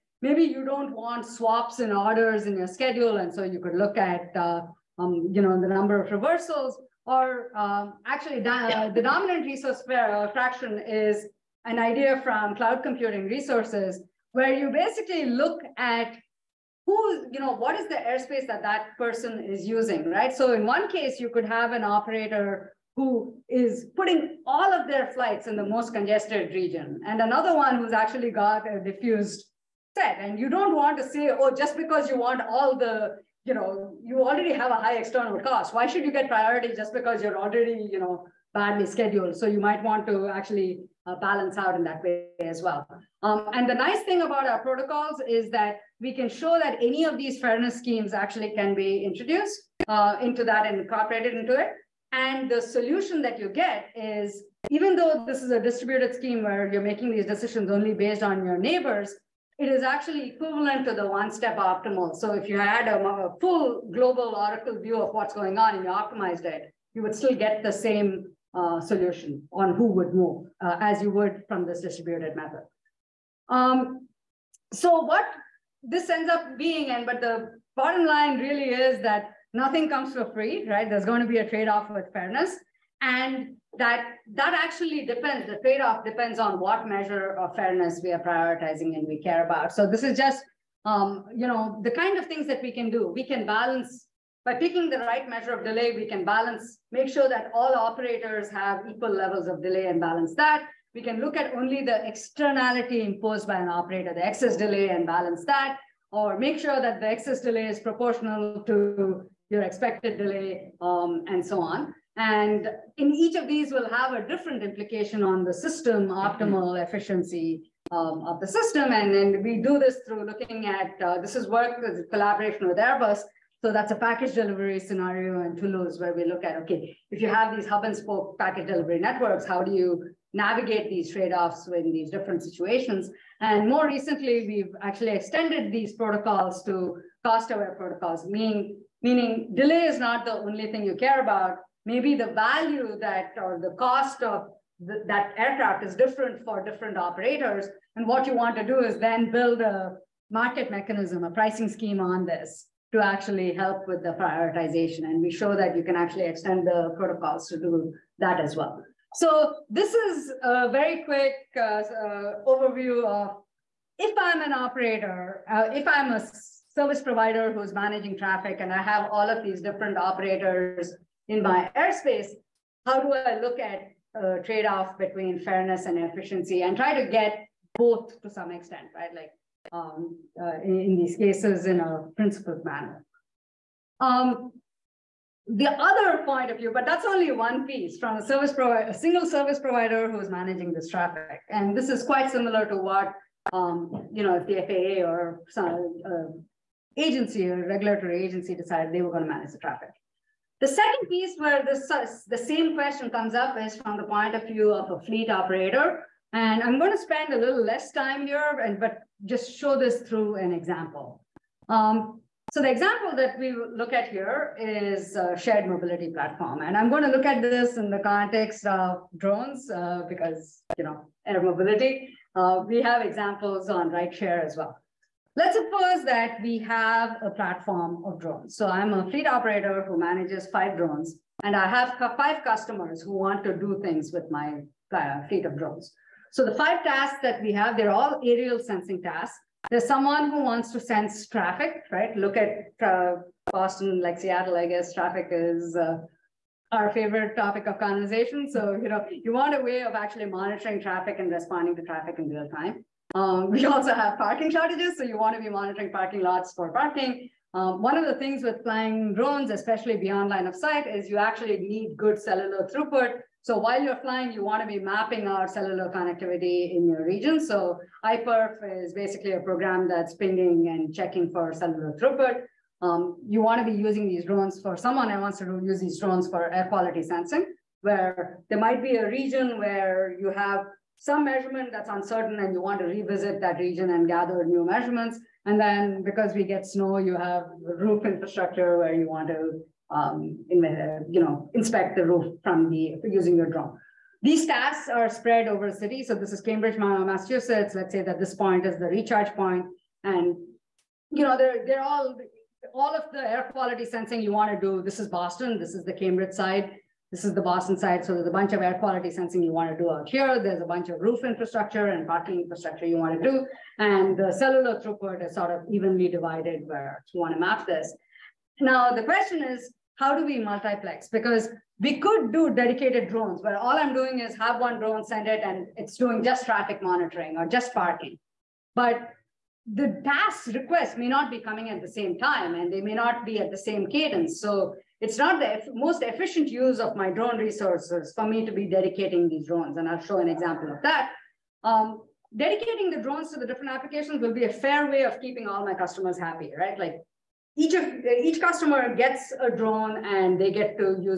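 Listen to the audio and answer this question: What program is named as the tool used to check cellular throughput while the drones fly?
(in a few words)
iPerf.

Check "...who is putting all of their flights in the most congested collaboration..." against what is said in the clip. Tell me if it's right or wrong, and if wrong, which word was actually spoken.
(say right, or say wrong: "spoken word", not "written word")
wrong: "region", not "collaboration".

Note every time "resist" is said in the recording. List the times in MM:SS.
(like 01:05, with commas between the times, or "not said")
not said.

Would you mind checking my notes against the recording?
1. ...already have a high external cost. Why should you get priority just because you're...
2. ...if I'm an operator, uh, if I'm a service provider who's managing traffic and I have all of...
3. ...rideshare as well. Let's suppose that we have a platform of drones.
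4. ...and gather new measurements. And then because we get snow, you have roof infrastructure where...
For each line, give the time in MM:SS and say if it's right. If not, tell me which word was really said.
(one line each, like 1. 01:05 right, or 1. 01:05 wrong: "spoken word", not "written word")
1. 00:34 right
2. 02:43 right
3. 03:43 right
4. 04:43 right.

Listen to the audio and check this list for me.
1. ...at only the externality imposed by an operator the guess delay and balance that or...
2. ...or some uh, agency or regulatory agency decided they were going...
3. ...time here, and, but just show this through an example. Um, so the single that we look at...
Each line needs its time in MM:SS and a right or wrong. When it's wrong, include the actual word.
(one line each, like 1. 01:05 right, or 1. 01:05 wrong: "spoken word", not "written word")
1. 01:41 wrong: "excess", not "guess"
2. 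03:15 right
3. 03:27 wrong: "example", not "single".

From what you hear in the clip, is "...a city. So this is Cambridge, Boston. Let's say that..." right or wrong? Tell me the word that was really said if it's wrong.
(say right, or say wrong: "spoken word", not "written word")
wrong: "Massachusetts", not "Boston".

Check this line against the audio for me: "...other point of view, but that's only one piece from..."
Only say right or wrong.
right.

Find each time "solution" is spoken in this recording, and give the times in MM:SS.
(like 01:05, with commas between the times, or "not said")
00:52, 01:08.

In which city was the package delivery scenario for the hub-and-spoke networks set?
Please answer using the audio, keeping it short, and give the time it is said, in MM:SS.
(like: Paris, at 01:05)
Toulouse, at 02:05.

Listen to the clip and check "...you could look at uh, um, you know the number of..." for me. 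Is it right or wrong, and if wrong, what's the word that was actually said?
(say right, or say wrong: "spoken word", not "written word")
right.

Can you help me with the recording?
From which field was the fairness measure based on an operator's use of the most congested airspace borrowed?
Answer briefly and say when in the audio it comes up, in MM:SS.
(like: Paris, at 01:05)
Cloud computing, at 00:12.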